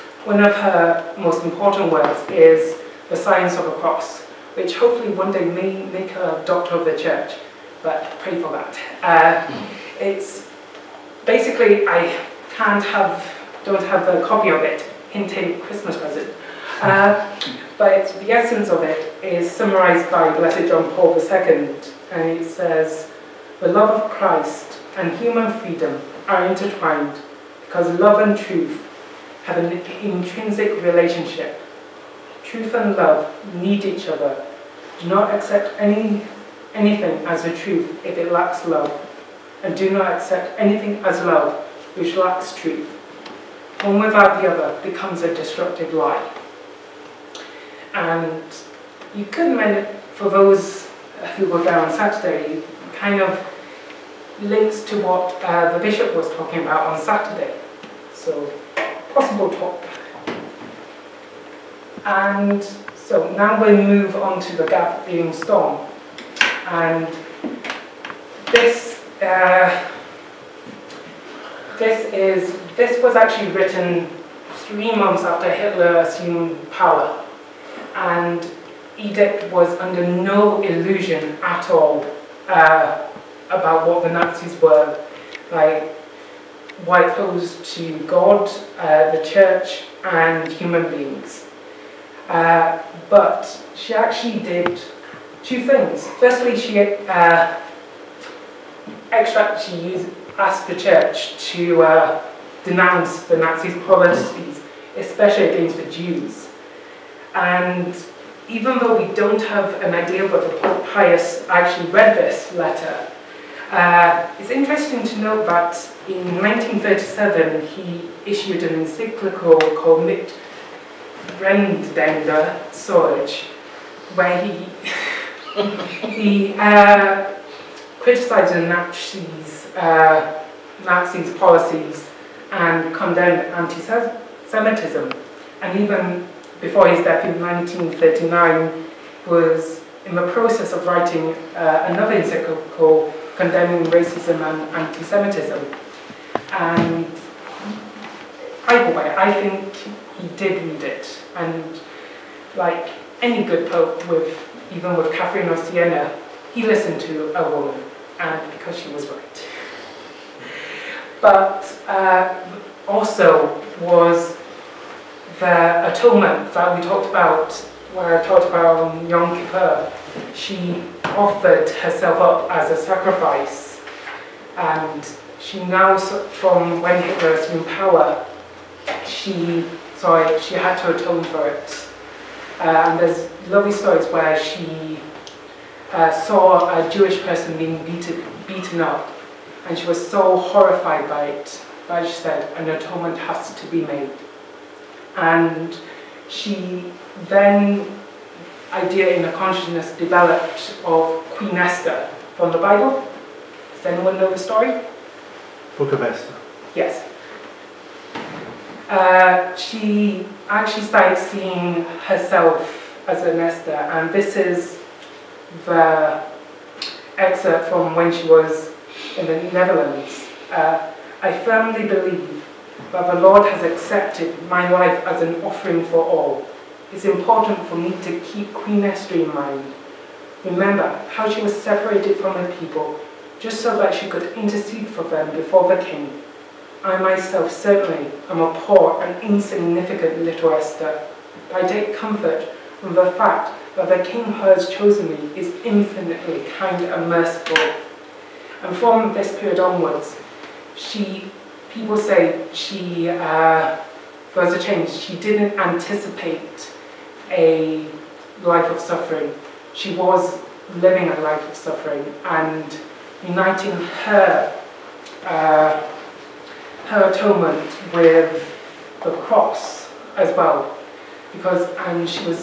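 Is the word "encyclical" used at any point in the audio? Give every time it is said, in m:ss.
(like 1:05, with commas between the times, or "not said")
1:58, 2:22.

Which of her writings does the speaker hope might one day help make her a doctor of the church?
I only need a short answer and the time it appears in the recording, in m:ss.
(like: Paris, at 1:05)
The Science of the Cross, at 0:03.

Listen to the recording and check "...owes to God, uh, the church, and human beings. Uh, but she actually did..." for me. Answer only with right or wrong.
right.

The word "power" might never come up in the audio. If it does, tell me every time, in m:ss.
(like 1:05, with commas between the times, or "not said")
1:16, 2:57.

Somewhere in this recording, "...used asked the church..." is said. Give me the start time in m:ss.
1:39.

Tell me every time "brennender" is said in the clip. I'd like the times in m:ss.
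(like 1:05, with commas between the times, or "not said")
2:01.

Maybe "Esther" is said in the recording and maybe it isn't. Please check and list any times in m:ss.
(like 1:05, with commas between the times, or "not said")
3:21, 3:26, 3:48, 4:00.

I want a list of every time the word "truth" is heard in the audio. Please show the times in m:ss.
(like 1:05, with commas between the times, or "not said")
0:28, 0:32, 0:37, 0:42.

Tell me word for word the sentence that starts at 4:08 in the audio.
And from this period onwards, she, people say she, uh, there was a change.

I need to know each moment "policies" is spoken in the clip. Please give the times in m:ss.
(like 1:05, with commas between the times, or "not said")
1:43, 2:11.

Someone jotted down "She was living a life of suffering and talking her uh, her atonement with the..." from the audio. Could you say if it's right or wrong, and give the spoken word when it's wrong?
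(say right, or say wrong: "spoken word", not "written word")
wrong: "uniting", not "talking".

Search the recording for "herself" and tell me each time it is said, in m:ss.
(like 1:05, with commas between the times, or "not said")
2:51, 3:32.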